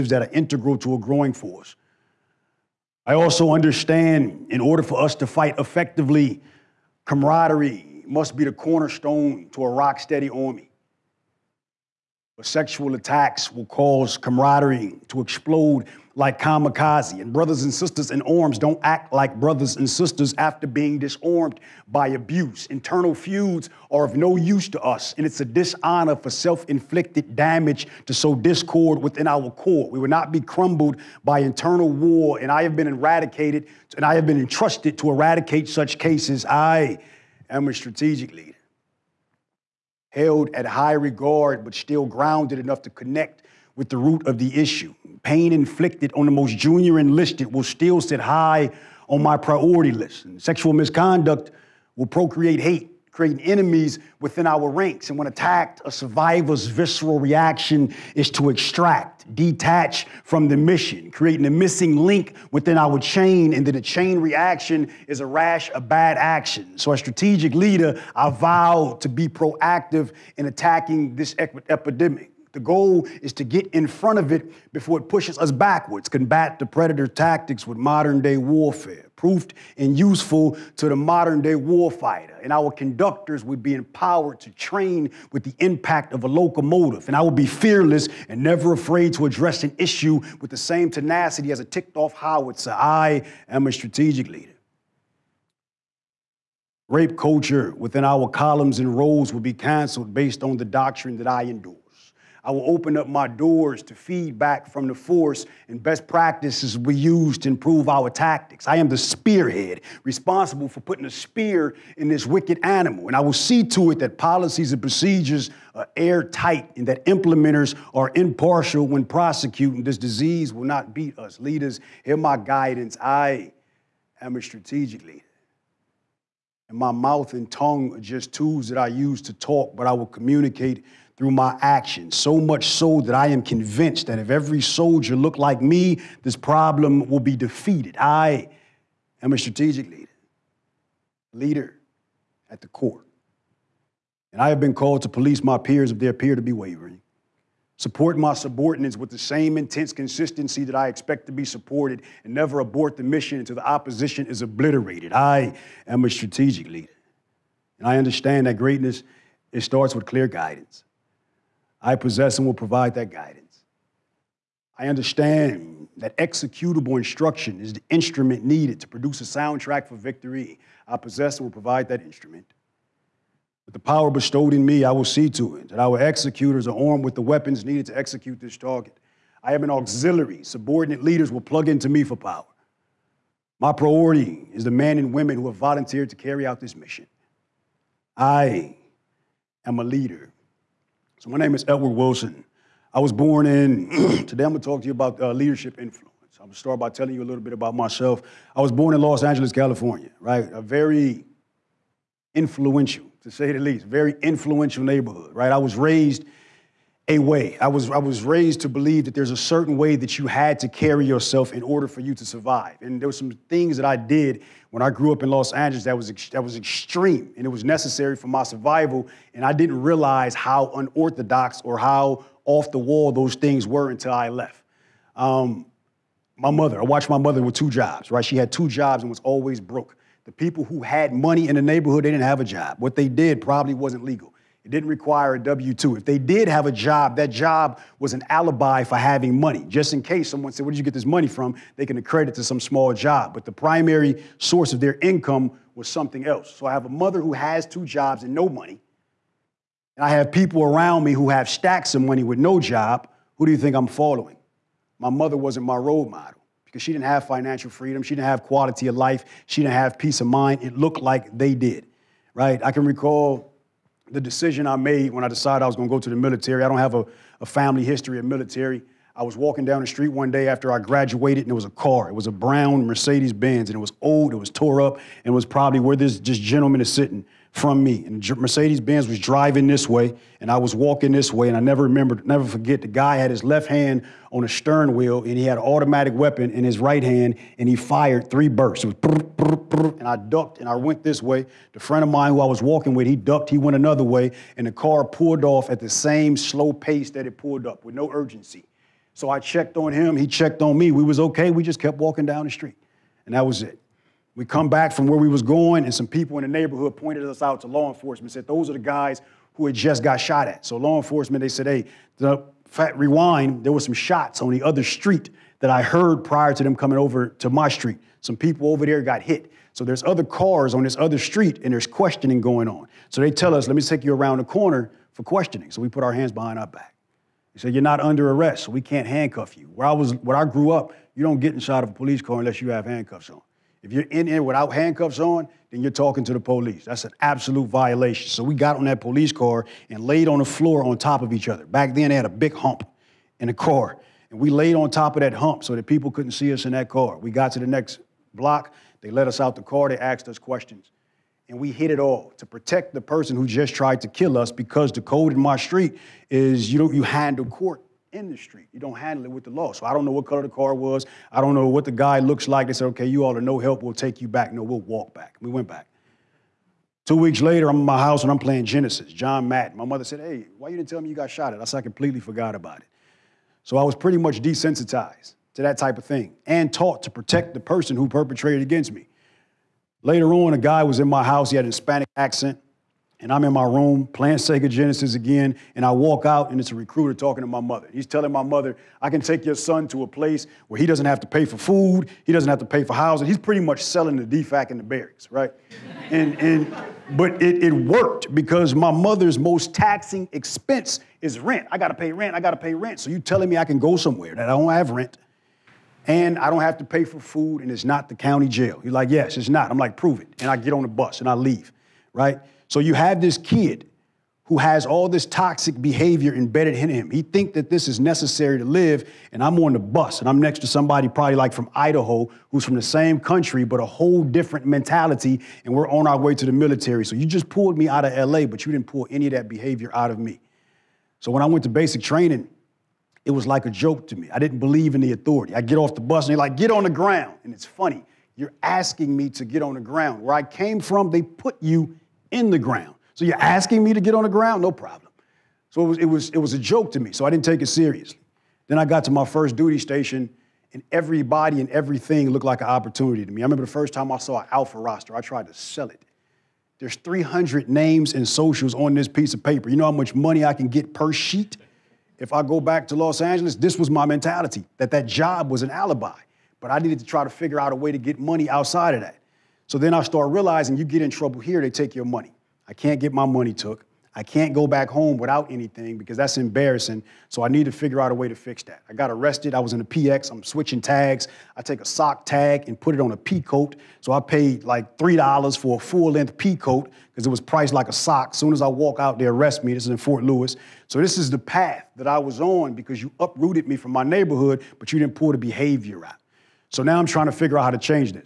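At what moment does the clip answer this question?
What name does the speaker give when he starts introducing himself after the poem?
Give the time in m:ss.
3:11.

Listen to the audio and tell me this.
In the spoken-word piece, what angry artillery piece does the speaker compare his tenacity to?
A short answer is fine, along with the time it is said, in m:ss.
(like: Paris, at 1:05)
howitzer, at 1:32.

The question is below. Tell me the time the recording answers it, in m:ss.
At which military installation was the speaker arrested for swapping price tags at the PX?
8:09.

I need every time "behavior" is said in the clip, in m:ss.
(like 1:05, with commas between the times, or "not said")
6:55, 7:09, 8:15.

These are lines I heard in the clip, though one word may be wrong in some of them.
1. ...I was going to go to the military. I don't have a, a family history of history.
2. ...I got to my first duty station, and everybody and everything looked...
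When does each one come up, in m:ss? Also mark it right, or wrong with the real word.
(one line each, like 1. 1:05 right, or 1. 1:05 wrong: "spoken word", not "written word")
1. 4:25 wrong: "military", not "history"
2. 7:28 right.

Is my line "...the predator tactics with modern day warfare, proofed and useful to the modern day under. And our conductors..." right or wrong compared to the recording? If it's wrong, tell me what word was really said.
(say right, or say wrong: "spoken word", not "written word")
wrong: "warfighter", not "under".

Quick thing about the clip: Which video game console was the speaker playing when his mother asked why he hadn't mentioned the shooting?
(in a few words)
Sega Genesis.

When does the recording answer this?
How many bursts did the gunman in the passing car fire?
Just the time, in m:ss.
4:48.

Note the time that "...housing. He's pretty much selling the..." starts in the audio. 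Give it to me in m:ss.
6:32.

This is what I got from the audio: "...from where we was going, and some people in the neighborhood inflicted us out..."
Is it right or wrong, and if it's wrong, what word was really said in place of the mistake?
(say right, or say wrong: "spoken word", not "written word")
wrong: "pointed", not "inflicted".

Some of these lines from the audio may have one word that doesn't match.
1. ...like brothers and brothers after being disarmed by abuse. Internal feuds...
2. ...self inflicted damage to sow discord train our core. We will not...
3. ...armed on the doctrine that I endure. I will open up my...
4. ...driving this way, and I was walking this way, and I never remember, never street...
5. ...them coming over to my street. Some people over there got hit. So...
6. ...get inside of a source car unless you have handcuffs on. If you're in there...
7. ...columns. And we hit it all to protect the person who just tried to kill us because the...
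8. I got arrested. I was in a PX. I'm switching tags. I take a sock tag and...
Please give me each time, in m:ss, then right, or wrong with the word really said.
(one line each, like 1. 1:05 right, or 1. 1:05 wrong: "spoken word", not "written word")
1. 0:19 wrong: "sisters", not "brothers"
2. 0:26 wrong: "within", not "train"
3. 1:40 wrong: "based", not "armed"
4. 4:39 wrong: "forget", not "street"
5. 5:16 right
6. 5:31 wrong: "police", not "source"
7. 5:50 wrong: "questions", not "columns"
8. 7:58 right.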